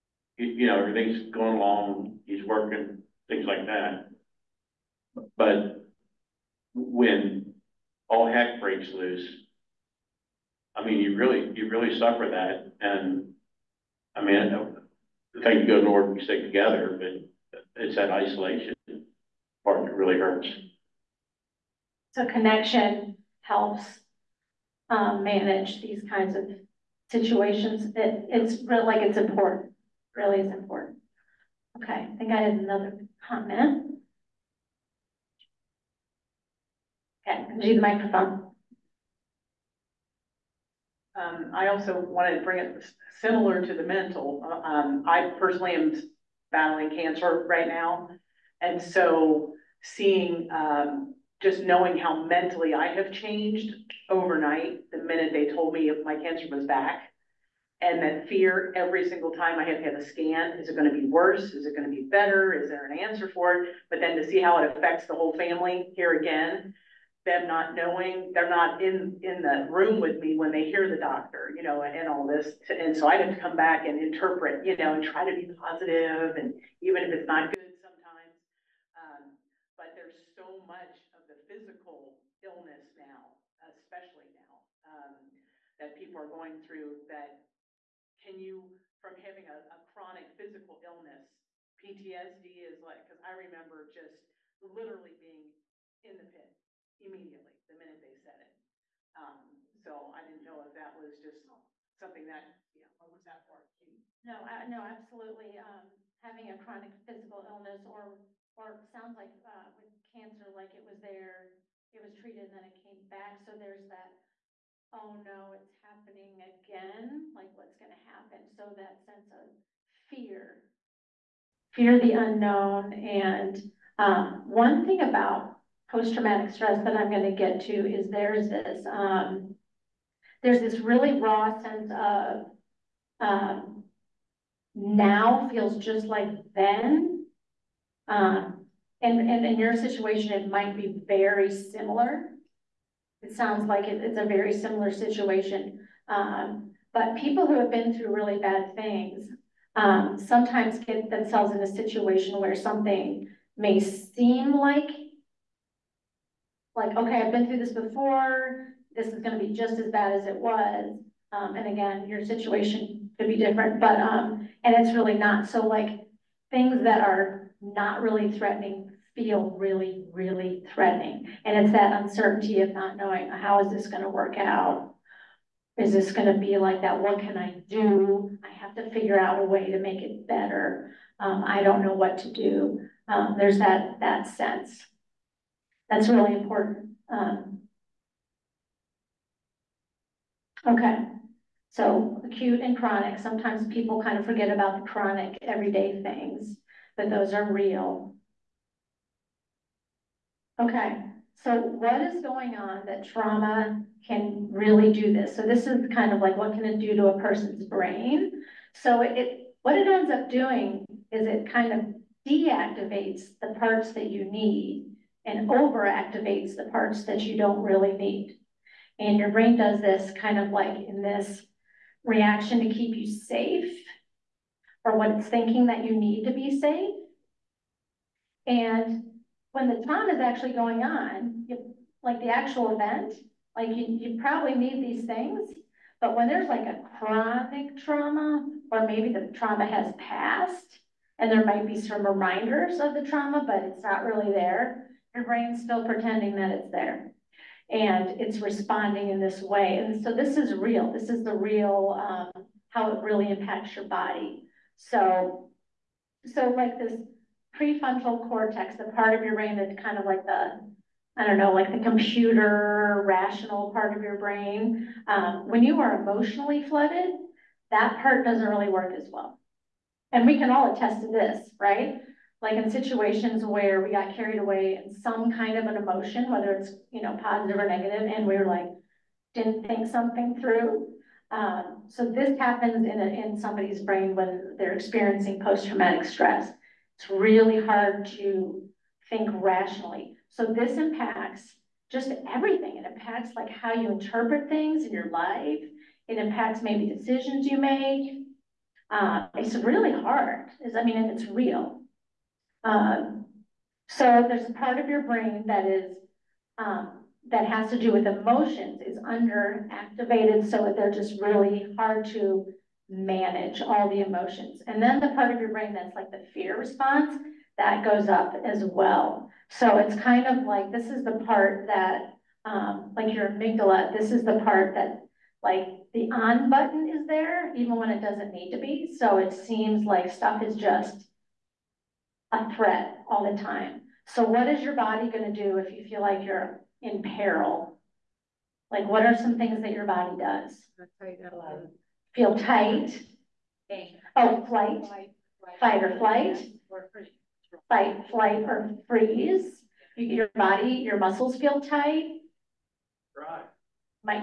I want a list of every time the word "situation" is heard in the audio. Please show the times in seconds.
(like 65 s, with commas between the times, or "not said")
27 s, 139 s, 144 s, 151 s, 162 s, 272 s.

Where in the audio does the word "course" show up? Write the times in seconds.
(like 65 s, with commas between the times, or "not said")
not said.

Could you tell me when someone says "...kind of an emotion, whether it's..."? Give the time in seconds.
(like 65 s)
275 s.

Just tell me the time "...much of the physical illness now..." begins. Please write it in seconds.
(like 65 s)
80 s.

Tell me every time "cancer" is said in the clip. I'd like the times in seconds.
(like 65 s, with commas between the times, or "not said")
46 s, 56 s, 110 s.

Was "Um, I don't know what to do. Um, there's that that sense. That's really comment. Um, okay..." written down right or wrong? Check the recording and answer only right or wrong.
wrong.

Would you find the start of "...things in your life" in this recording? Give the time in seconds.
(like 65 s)
294 s.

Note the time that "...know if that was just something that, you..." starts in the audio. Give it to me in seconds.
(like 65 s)
100 s.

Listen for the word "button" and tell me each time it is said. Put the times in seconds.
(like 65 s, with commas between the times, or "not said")
326 s.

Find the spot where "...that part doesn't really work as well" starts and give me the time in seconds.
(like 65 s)
267 s.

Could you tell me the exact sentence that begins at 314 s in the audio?
And then the part of your brain that's like the fear response, that goes up as well.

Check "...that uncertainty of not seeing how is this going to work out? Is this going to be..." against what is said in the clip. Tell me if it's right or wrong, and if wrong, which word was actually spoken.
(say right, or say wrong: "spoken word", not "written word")
wrong: "knowing", not "seeing".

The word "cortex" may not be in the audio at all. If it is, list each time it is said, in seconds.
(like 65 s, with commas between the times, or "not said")
258 s.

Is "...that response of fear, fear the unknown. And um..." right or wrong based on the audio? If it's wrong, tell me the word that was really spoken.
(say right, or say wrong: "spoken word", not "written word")
wrong: "sense", not "response".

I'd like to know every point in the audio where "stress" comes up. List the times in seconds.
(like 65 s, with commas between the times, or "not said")
126 s, 286 s.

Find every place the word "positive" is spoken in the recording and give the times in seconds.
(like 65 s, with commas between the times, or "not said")
75 s, 277 s.